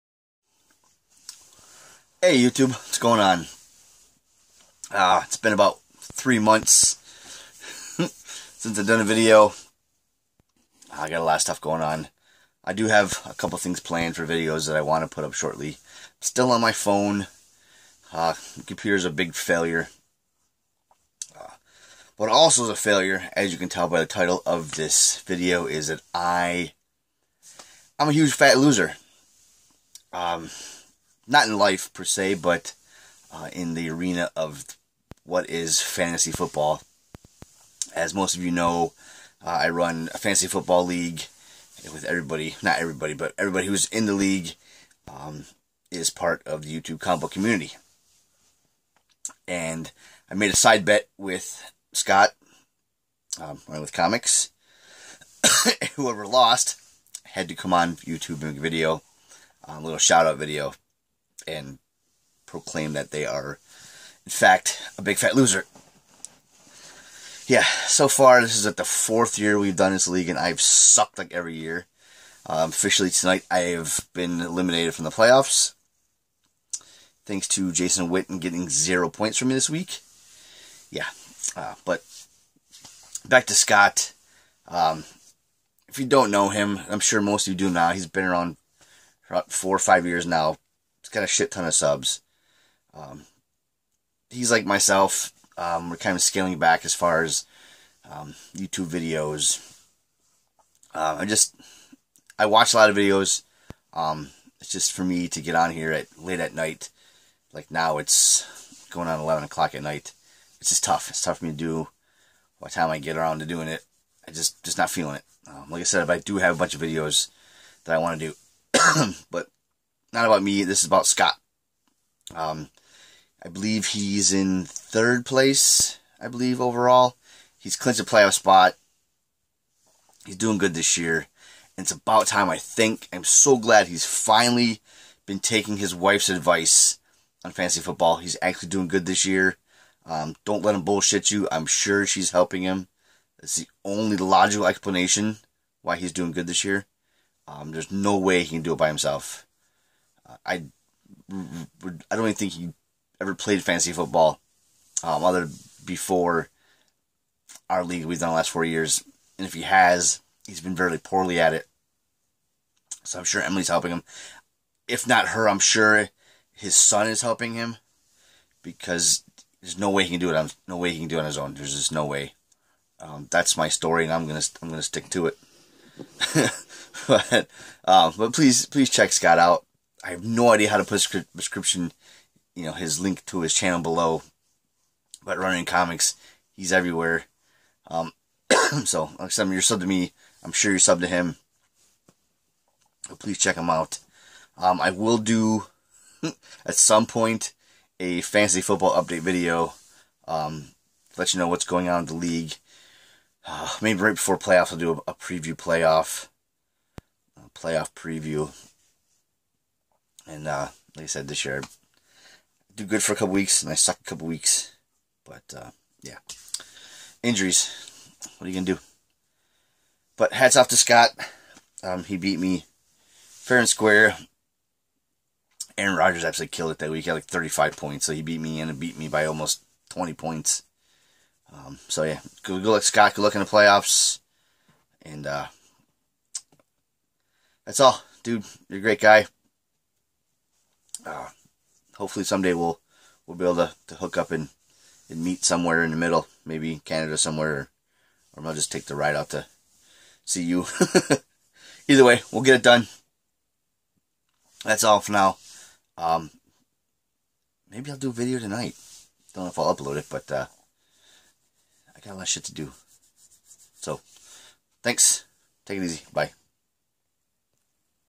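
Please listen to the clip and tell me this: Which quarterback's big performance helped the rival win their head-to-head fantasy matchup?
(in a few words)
Aaron Rodgers.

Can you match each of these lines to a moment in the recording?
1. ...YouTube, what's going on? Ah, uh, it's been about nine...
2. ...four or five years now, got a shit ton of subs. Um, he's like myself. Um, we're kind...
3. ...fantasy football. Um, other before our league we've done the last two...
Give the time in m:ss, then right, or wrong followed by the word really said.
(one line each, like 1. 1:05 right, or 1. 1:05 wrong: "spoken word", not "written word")
1. 0:02 wrong: "three", not "nine"
2. 1:29 right
3. 2:33 wrong: "four", not "two".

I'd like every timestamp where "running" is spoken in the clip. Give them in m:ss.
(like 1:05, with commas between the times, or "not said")
0:53, 3:05.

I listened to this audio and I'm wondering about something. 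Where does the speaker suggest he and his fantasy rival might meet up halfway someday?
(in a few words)
Canada.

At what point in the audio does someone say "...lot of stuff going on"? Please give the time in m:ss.
0:11.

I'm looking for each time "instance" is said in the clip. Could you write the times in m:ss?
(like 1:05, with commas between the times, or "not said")
not said.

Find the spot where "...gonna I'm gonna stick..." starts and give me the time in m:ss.
2:54.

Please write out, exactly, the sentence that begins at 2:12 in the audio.
I think I'm so glad he's finally been taking his wife's advice on fantasy football.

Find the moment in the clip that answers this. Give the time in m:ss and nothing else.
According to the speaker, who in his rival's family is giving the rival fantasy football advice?
2:43.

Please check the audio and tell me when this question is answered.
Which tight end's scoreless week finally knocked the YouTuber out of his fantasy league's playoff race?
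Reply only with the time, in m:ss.
1:17.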